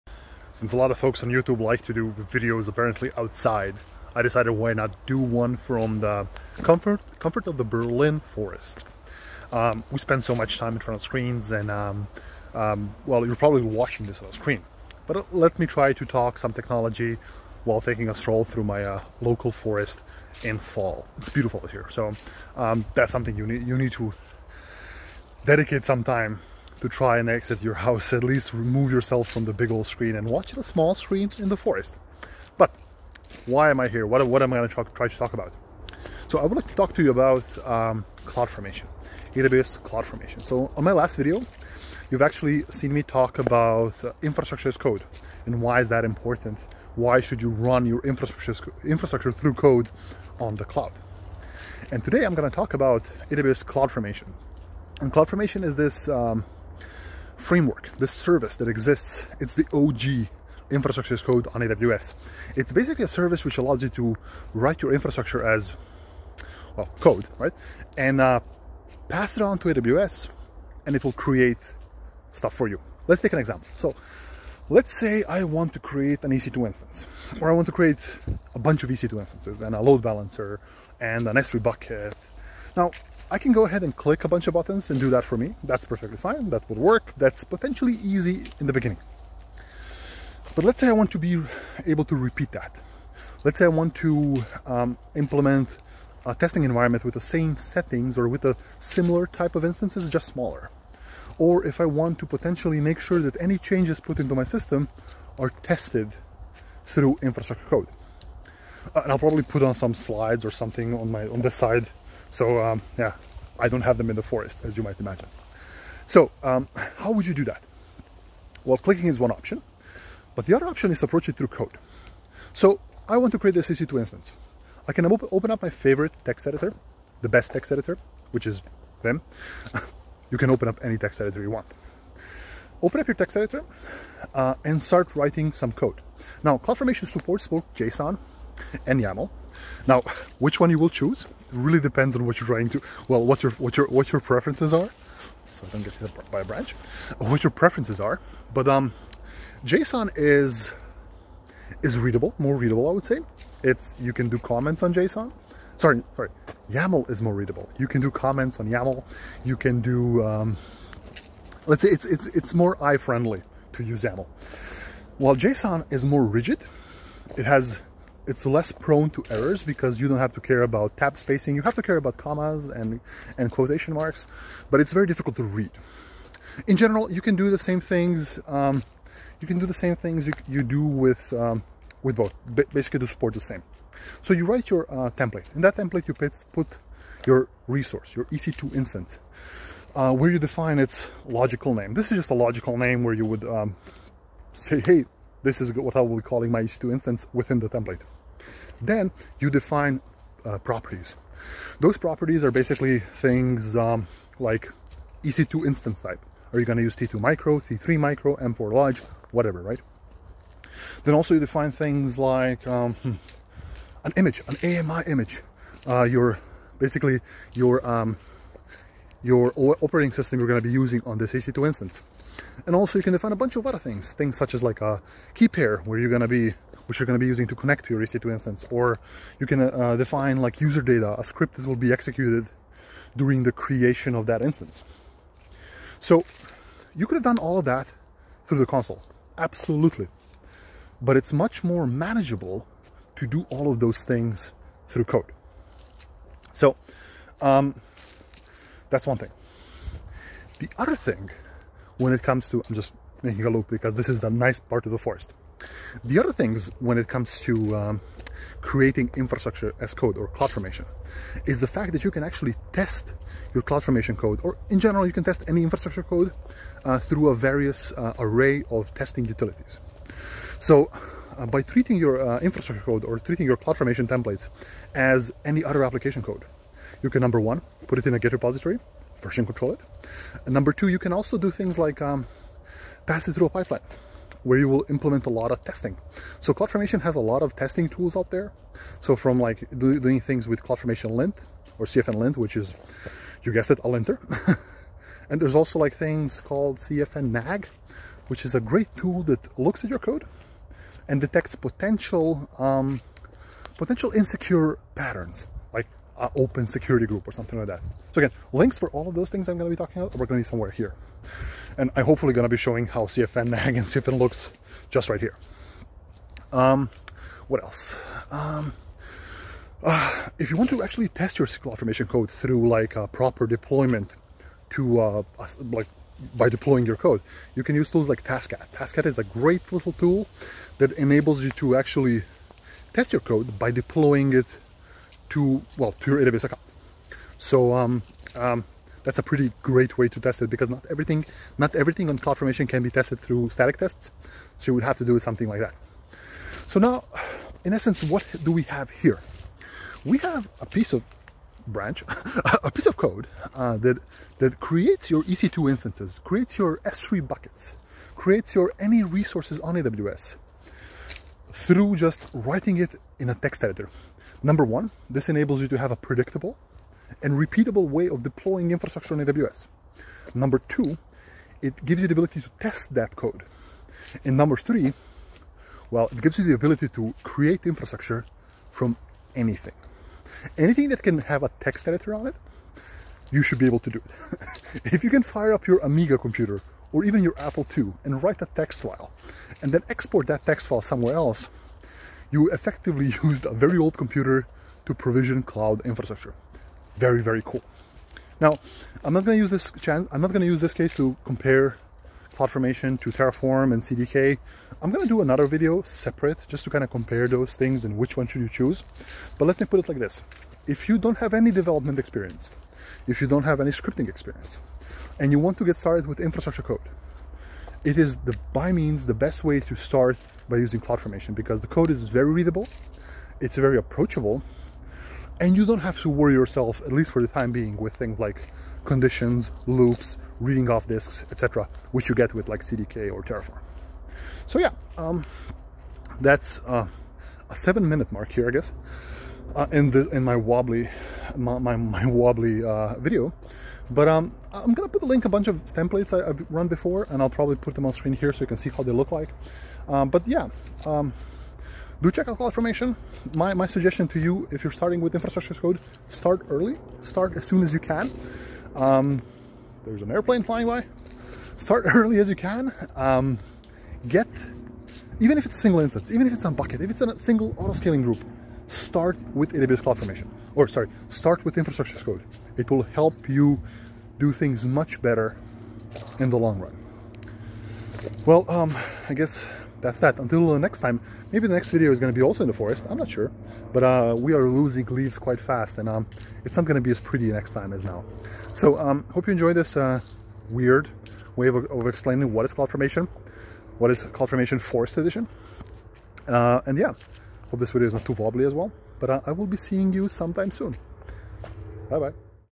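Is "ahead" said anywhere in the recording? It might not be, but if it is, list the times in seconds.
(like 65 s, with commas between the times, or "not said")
83 s.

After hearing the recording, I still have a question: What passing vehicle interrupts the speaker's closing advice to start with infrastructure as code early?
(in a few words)
An airplane.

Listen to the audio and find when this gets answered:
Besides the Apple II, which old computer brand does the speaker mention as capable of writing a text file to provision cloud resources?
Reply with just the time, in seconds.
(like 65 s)
385 s.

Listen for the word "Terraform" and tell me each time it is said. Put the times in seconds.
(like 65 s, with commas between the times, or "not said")
403 s, 433 s.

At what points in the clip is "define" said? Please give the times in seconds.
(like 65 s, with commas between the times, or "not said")
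190 s, 199 s, 211 s, 223 s, 229 s.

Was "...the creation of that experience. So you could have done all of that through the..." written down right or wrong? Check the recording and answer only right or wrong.
wrong.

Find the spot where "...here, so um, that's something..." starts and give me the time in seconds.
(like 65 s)
21 s.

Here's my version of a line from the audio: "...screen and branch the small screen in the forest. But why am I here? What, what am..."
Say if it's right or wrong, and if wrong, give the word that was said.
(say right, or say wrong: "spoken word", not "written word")
wrong: "watch", not "branch".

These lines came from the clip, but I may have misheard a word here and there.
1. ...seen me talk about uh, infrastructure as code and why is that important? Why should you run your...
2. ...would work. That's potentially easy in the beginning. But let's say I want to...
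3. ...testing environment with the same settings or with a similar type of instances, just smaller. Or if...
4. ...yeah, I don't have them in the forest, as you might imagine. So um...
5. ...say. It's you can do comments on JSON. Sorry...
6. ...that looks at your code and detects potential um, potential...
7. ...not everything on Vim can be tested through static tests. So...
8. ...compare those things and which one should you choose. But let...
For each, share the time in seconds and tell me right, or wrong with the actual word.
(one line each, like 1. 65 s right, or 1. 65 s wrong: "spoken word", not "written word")
1. 42 s right
2. 86 s right
3. 96 s right
4. 112 s right
5. 153 s right
6. 299 s right
7. 341 s wrong: "CloudFormation", not "Vim"
8. 406 s right.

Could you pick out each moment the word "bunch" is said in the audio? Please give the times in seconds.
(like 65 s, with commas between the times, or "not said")
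78 s, 84 s, 223 s, 445 s.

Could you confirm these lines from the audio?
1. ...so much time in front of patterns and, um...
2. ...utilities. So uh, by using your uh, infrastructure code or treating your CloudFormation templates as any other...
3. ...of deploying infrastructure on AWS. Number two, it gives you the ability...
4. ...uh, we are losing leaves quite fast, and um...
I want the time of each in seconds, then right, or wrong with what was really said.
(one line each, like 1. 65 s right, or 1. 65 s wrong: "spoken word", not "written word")
1. 10 s wrong: "screens", not "patterns"
2. 269 s wrong: "treating", not "using"
3. 368 s right
4. 483 s right.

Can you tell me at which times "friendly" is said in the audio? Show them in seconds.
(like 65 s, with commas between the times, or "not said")
162 s.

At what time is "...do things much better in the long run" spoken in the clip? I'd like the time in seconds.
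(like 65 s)
474 s.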